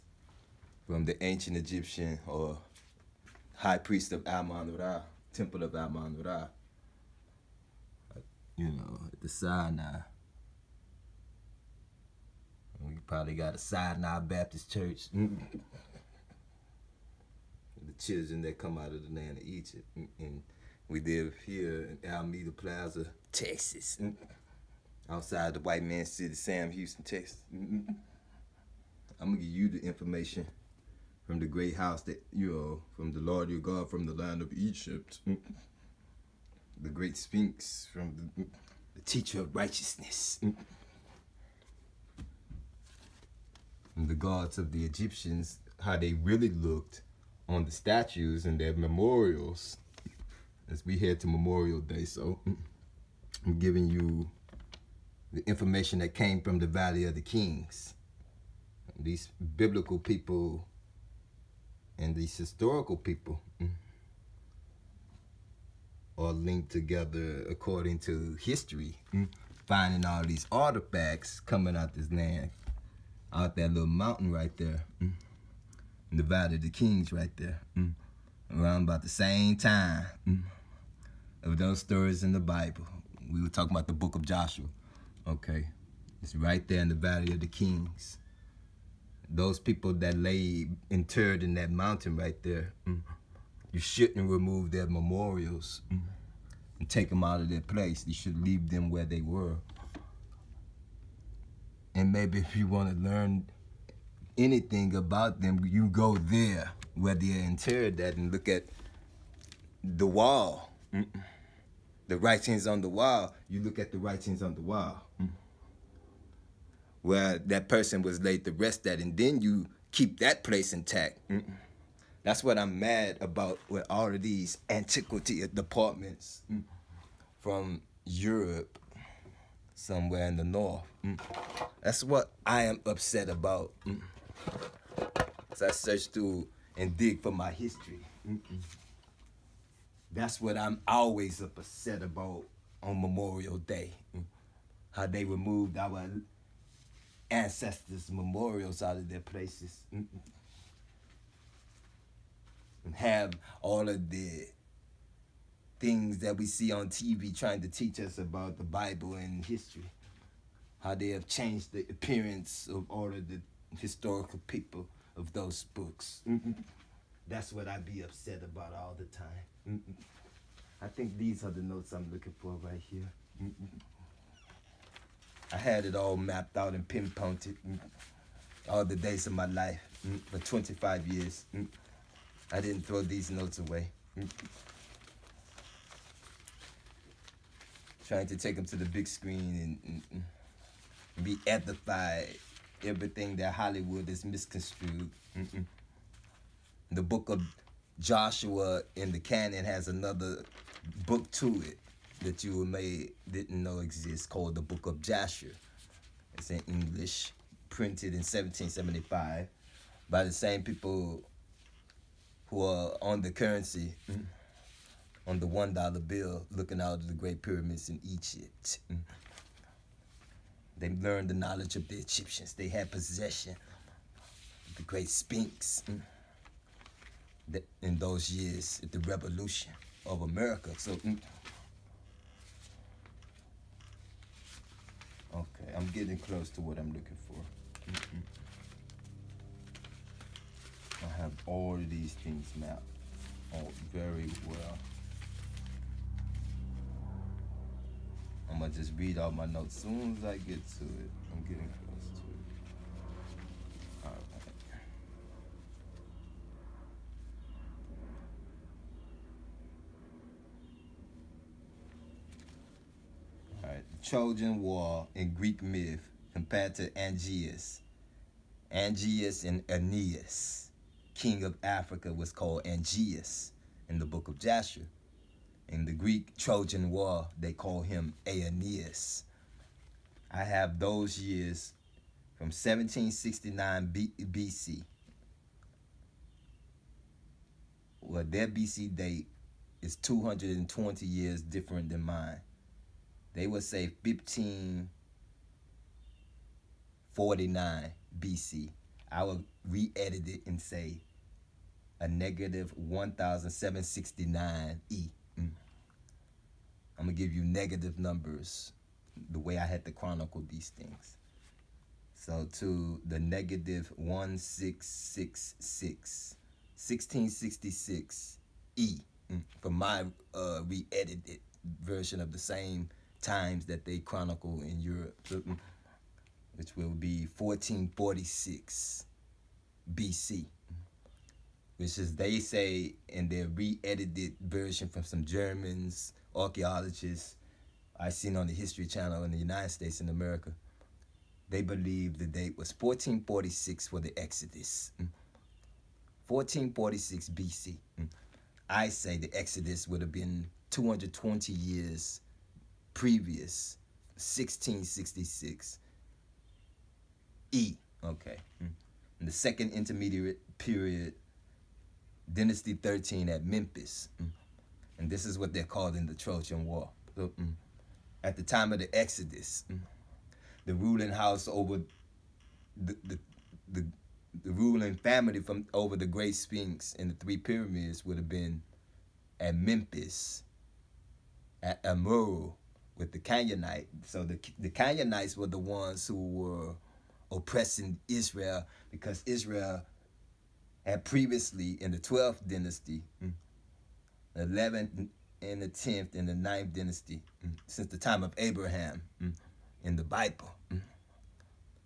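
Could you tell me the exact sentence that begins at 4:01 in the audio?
I have all of these things mapped all very well.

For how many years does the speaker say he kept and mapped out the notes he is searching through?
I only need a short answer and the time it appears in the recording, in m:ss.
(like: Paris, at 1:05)
25, at 3:00.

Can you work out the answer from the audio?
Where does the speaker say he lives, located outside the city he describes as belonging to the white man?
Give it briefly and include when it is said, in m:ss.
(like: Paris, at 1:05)
Alameda Plaza, Texas, at 0:22.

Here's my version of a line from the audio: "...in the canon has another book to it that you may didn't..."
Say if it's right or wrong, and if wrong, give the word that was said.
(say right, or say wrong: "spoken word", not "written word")
right.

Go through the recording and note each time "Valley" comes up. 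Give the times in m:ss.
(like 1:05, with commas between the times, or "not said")
0:56, 1:16, 1:26.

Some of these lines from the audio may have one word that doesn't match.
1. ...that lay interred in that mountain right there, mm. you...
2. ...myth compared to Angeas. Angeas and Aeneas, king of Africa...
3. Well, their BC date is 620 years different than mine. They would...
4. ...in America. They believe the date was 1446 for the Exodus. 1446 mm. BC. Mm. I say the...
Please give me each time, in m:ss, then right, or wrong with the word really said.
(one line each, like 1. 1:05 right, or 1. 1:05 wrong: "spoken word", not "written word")
1. 1:29 right
2. 4:25 right
3. 4:47 wrong: "220", not "620"
4. 5:40 right.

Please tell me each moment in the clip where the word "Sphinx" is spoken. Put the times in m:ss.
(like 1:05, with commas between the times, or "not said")
0:37, 3:45, 6:16.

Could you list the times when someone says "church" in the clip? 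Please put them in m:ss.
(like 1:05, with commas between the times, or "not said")
0:14.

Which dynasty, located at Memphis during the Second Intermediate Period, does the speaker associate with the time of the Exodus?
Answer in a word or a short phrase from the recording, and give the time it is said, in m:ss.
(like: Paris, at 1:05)
Dynasty 13, at 6:02.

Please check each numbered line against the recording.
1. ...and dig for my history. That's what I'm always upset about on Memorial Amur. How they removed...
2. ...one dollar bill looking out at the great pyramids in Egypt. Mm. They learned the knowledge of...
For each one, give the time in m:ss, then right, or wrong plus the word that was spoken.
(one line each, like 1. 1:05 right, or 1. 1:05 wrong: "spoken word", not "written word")
1. 2:16 wrong: "Day", not "Amur"
2. 3:35 right.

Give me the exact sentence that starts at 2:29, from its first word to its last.
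And have all of the things that we see on TV trying to teach us about the Bible and history.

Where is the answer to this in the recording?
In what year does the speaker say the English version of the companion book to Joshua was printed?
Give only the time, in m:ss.
3:28.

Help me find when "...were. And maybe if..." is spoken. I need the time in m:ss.
1:39.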